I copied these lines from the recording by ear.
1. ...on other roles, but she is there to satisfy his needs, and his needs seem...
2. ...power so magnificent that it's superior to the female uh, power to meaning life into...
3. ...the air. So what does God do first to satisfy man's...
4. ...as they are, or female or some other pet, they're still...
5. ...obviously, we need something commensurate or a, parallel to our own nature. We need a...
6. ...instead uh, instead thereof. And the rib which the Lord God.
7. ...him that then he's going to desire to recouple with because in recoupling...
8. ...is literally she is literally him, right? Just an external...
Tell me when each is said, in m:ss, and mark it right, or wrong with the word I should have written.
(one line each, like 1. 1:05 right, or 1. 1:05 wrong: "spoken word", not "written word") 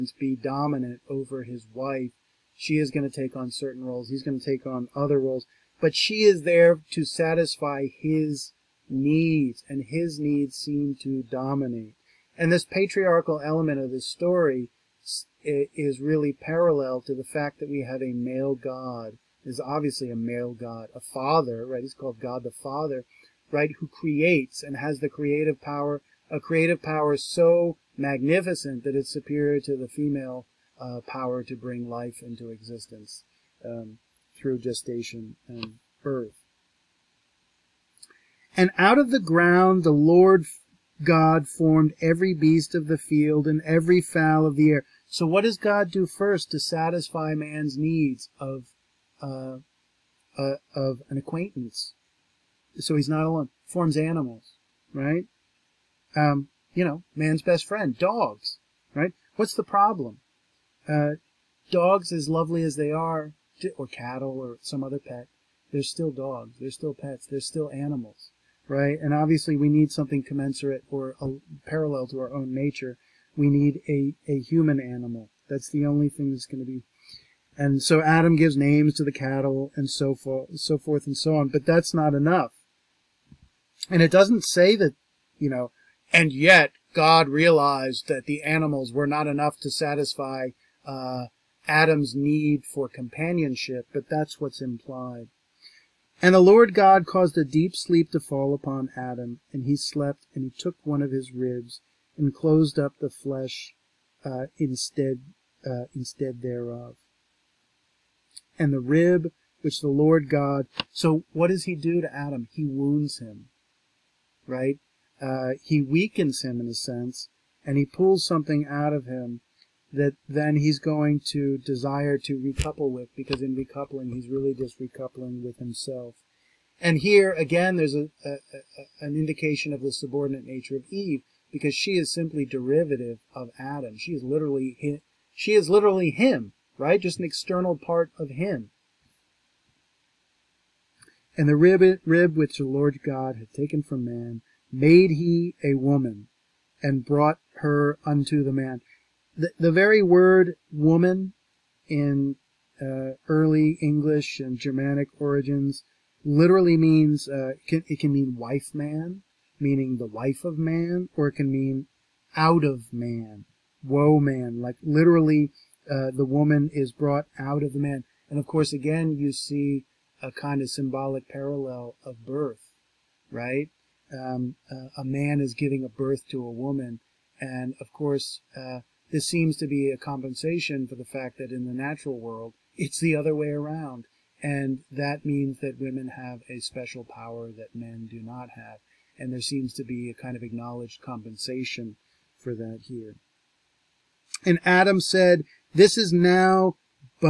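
1. 0:04 right
2. 0:26 wrong: "bring", not "meaning"
3. 0:44 right
4. 1:02 wrong: "cattle", not "female"
5. 1:09 right
6. 1:44 right
7. 1:59 right
8. 2:14 right.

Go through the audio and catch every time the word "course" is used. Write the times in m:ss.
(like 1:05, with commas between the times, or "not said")
2:48, 2:57.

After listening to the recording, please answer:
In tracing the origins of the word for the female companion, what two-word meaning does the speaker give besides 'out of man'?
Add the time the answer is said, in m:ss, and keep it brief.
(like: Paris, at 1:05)
wife man, at 2:38.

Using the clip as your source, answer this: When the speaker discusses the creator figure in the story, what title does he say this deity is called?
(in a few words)
God the Father.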